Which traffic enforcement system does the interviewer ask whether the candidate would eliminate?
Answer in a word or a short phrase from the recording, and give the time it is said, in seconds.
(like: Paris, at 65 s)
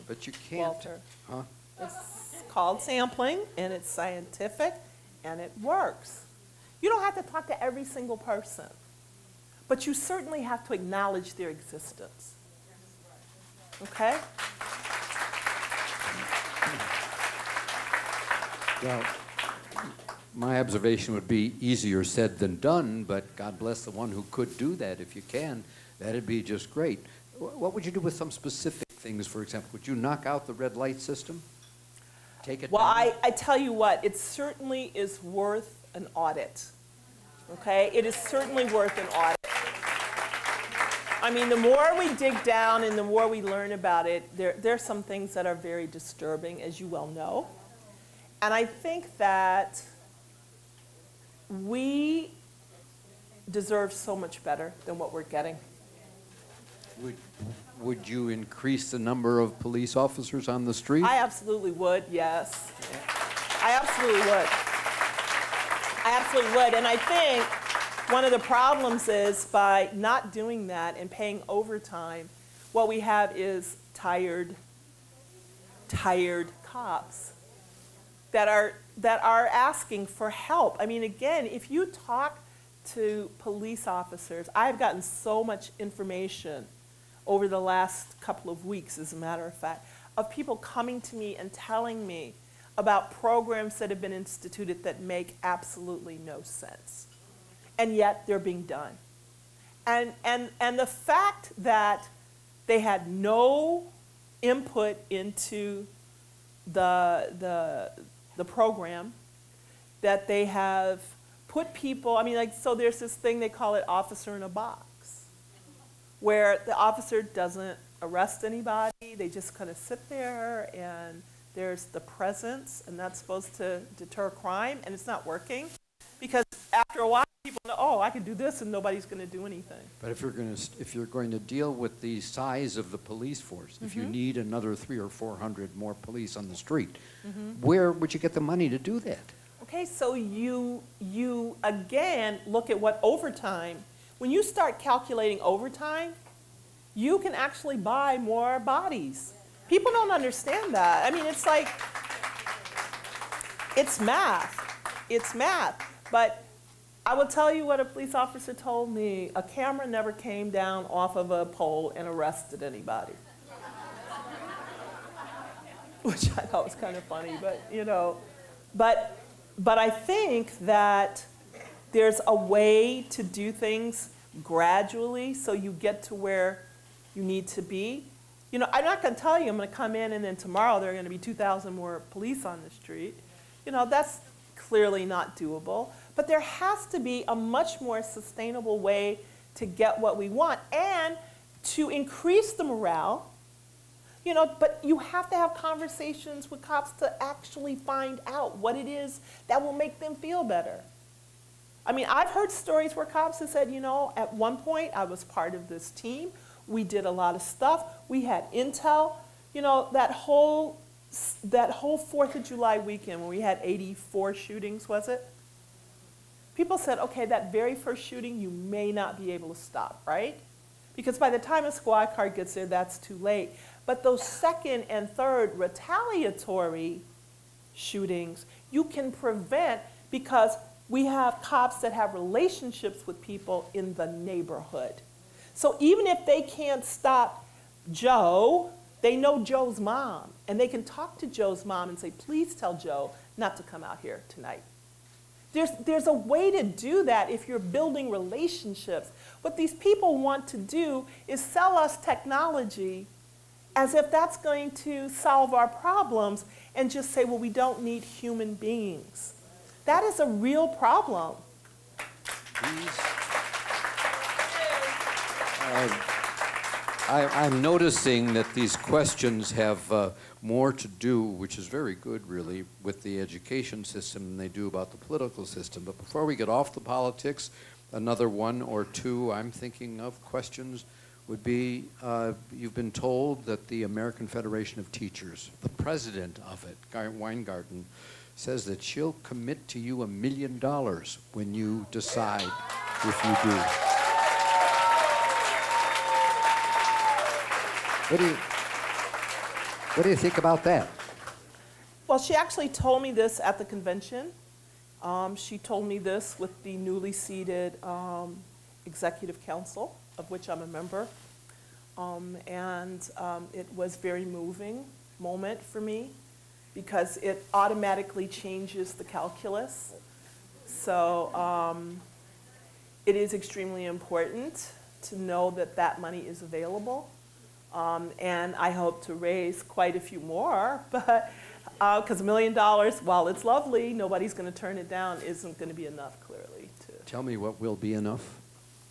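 red light system, at 30 s.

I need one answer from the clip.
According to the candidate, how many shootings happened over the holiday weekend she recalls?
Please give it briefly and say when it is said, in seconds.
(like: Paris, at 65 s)
84, at 213 s.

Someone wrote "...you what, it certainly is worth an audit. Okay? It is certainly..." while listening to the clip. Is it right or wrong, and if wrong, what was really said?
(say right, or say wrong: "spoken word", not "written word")
right.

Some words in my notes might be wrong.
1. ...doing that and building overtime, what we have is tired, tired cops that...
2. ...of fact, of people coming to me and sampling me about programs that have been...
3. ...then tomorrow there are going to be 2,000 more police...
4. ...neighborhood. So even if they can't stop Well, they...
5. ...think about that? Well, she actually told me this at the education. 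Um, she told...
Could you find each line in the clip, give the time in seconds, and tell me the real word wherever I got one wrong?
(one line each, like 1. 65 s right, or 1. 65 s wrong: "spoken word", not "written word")
1. 70 s wrong: "paying", not "building"
2. 89 s wrong: "telling", not "sampling"
3. 180 s right
4. 234 s wrong: "Joe", not "Well"
5. 300 s wrong: "convention", not "education".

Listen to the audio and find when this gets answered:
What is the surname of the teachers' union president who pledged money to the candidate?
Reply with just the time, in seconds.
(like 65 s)
286 s.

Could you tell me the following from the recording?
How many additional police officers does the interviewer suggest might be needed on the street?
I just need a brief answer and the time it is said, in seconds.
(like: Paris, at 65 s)
300 or 400, at 134 s.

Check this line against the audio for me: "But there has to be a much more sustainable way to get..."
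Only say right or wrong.
right.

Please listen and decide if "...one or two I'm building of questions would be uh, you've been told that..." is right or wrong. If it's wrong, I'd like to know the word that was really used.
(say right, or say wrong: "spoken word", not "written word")
wrong: "thinking", not "building".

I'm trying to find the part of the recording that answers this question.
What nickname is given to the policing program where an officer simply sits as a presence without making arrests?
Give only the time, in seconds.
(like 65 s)
113 s.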